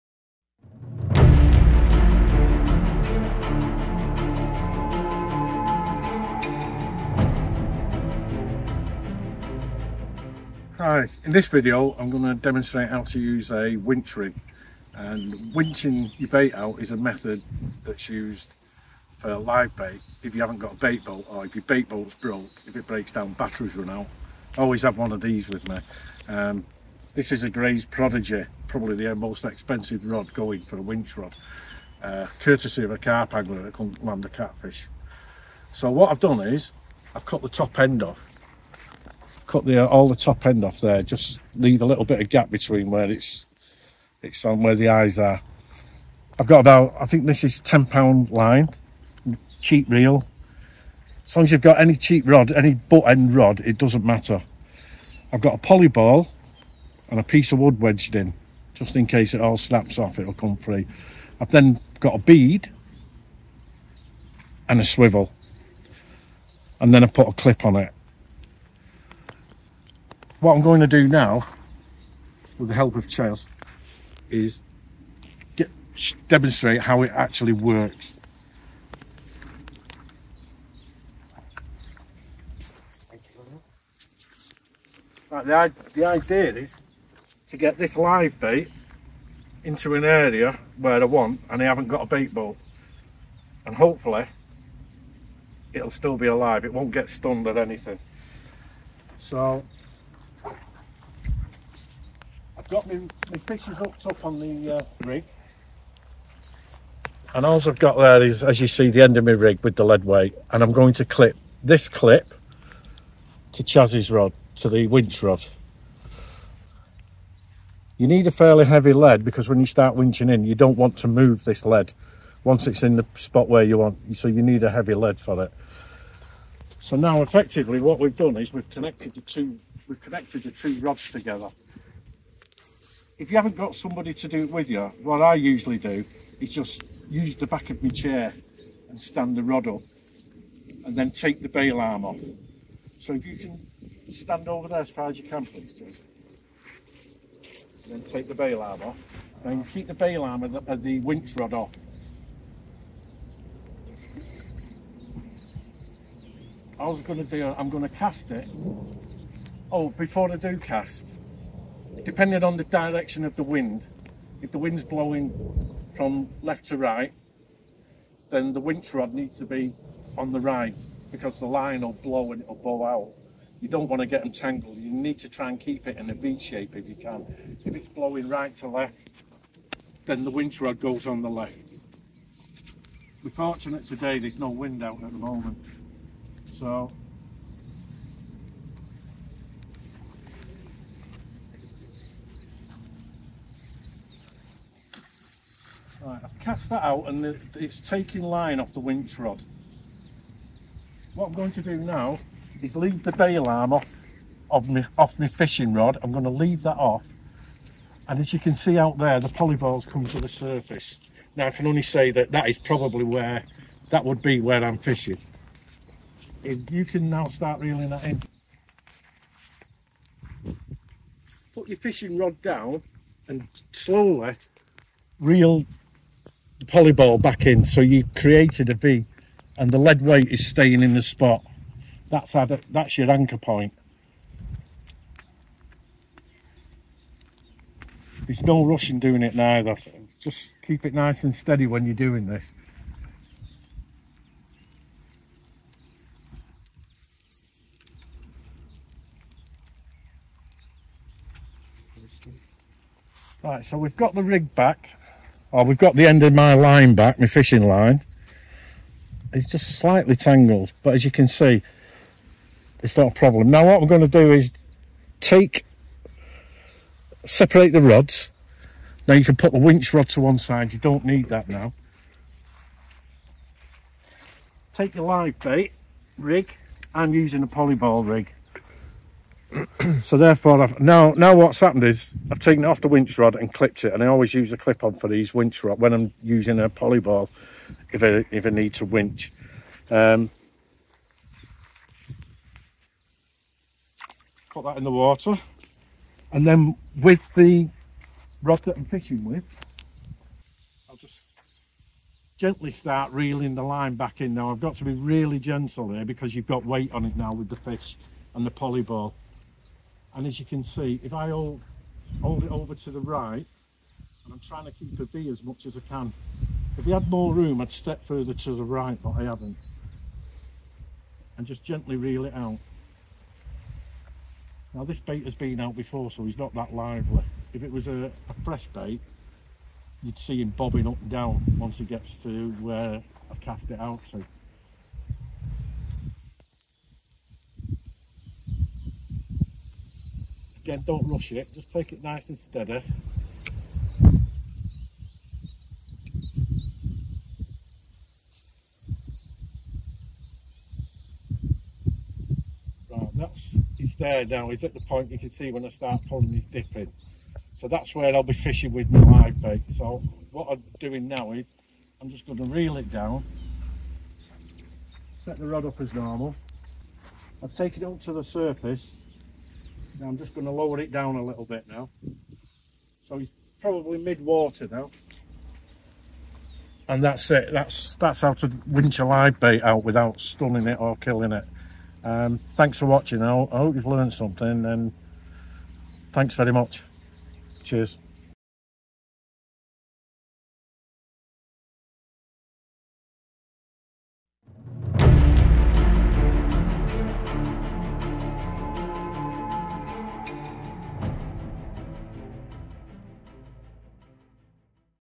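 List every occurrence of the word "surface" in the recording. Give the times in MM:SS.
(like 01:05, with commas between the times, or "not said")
03:30, 06:08.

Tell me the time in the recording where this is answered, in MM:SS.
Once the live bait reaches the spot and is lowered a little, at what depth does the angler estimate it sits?
06:13.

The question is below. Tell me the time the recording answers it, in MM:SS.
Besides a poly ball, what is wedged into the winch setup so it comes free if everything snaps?
00:57.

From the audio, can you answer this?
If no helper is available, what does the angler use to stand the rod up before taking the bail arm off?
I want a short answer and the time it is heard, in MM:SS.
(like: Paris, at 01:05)
the back of my chair, at 02:17.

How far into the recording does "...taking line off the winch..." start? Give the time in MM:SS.
03:17.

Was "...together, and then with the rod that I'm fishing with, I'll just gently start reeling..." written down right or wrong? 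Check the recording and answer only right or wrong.
wrong.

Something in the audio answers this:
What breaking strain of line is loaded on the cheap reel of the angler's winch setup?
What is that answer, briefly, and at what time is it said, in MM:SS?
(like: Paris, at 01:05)
10 pound, at 00:47.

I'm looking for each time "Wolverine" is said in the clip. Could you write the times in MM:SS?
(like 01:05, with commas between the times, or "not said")
not said.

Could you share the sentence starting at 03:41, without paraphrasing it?
Put your fishing rod down and slowly reel the polyball back in.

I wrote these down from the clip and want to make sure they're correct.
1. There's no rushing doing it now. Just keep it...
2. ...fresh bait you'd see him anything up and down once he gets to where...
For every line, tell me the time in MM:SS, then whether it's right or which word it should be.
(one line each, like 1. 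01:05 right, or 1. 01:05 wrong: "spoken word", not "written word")
1. 03:58 right
2. 05:28 wrong: "bobbing", not "anything".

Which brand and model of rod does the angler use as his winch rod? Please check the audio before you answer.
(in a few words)
Greys Prodigy.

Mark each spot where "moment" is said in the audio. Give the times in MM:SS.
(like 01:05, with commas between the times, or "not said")
03:05.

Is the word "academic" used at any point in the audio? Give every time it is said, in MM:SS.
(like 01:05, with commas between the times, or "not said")
not said.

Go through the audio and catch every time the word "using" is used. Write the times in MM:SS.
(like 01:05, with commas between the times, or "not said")
04:37, 04:46.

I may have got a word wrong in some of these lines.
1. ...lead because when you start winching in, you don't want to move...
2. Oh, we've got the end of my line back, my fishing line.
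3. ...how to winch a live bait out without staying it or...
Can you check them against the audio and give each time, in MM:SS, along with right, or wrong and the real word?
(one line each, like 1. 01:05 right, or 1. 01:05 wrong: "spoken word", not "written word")
1. 01:58 right
2. 04:15 right
3. 06:18 wrong: "stunning", not "staying".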